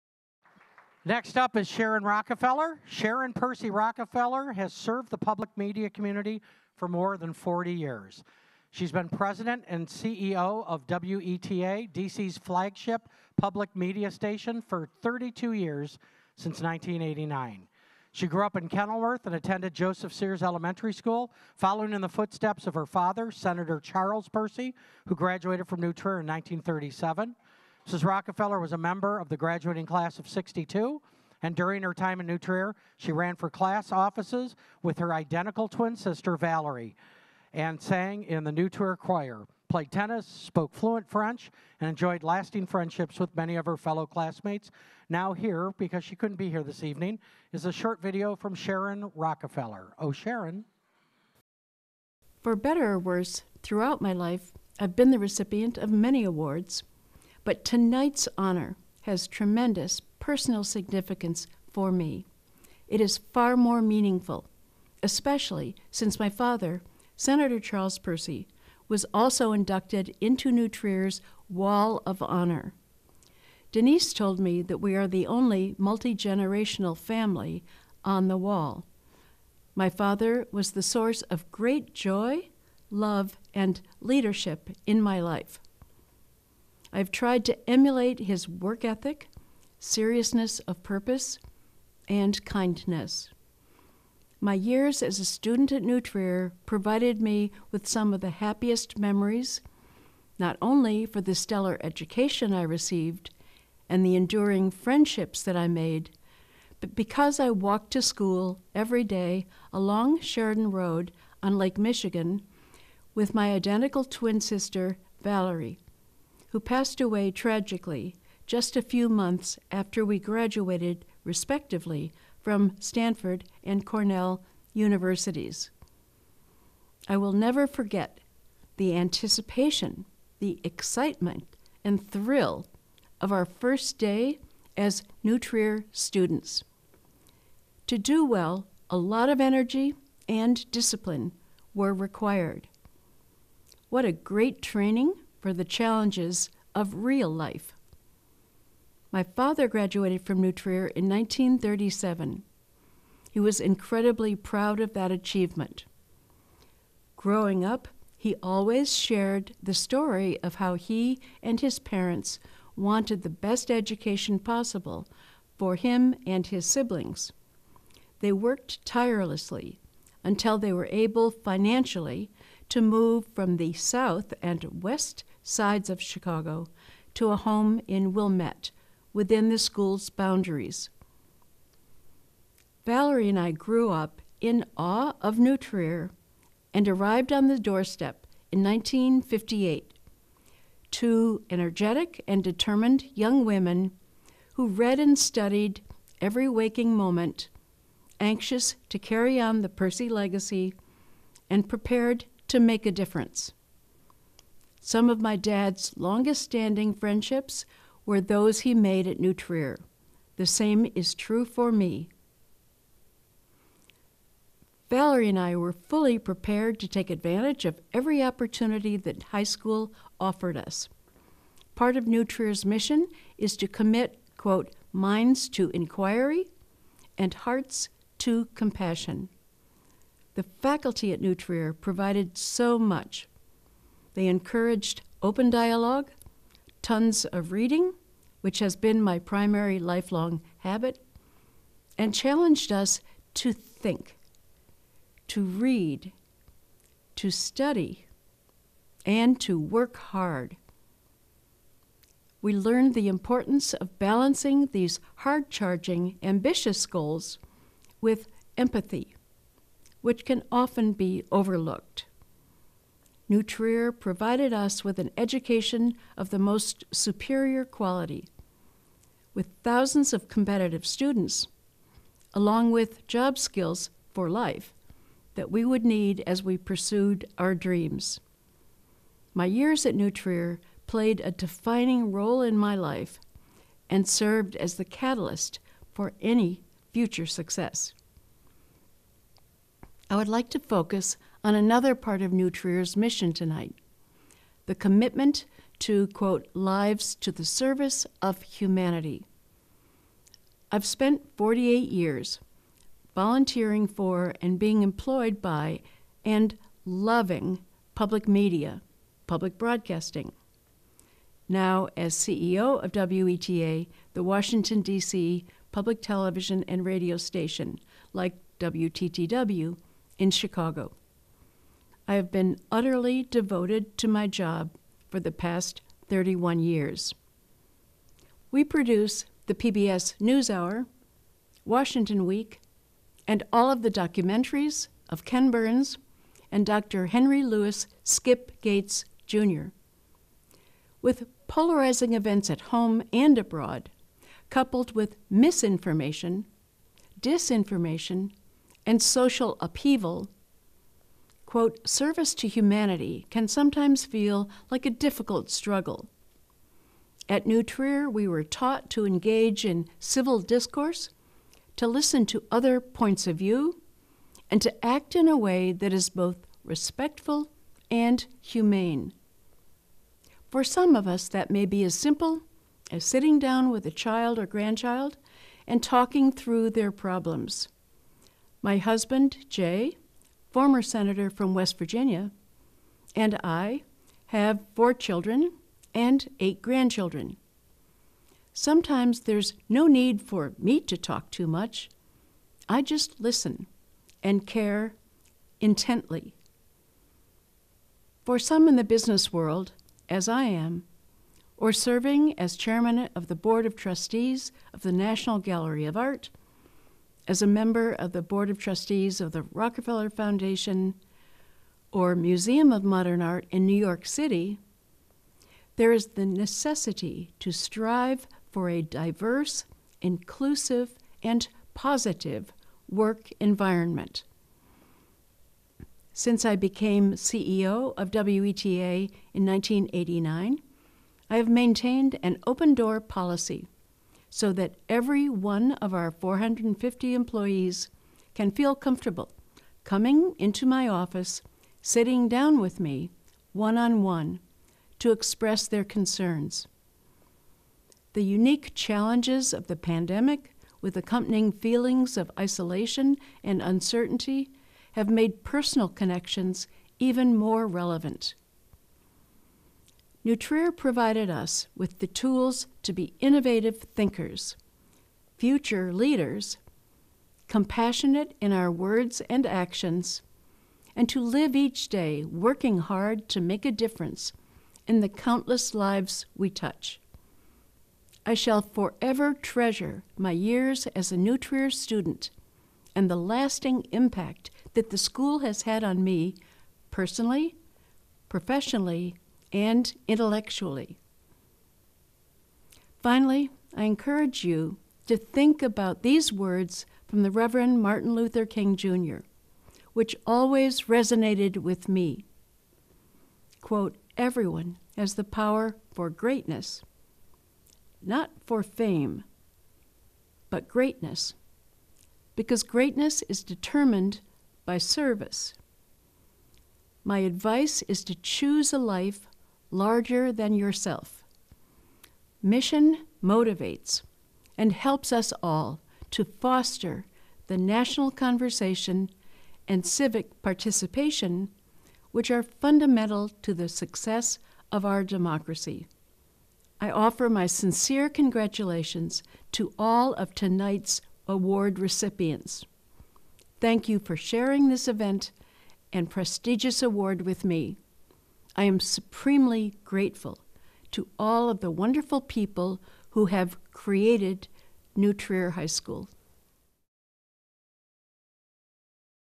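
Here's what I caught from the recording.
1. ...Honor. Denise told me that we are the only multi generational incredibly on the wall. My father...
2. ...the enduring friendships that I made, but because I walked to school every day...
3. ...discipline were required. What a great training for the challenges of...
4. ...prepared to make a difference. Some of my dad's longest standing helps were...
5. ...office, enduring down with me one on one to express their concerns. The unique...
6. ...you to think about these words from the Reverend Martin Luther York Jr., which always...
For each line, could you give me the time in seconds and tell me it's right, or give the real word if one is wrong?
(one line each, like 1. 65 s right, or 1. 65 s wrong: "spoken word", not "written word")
1. 72 s wrong: "family", not "incredibly"
2. 104 s right
3. 140 s right
4. 201 s wrong: "friendships", not "helps"
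5. 440 s wrong: "sitting", not "enduring"
6. 494 s wrong: "King", not "York".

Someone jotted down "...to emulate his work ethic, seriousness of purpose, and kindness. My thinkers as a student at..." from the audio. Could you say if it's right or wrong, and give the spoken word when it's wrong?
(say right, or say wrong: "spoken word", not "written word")
wrong: "years", not "thinkers".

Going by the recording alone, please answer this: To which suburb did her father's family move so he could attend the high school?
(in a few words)
Wilmette.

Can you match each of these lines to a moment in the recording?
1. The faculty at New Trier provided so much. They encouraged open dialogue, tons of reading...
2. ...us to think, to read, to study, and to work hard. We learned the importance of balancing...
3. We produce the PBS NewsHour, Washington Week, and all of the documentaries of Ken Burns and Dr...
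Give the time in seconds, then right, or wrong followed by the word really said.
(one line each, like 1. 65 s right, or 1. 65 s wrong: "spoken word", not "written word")
1. 230 s right
2. 242 s right
3. 328 s right.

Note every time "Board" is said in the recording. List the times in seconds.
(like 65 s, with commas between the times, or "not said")
403 s, 408 s.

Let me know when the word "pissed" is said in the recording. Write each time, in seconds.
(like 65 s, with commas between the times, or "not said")
not said.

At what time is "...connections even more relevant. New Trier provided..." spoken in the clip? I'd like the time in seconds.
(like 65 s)
455 s.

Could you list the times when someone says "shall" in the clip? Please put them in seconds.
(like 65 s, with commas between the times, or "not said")
478 s.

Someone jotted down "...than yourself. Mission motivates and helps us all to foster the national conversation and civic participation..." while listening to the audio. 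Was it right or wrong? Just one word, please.
right.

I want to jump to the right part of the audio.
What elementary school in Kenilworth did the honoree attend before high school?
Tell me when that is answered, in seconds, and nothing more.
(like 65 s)
19 s.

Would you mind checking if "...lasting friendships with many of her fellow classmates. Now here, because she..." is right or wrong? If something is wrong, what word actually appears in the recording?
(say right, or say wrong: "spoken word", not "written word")
right.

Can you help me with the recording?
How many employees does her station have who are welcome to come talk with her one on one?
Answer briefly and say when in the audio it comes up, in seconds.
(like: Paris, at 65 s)
450, at 436 s.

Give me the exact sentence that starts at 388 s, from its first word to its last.
Sometimes there's no need for me to talk too much.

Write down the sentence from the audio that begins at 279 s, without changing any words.
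My years at New Trier played a defining role in my life and served as the catalyst for any future success.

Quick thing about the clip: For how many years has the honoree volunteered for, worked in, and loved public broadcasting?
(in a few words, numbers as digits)
48.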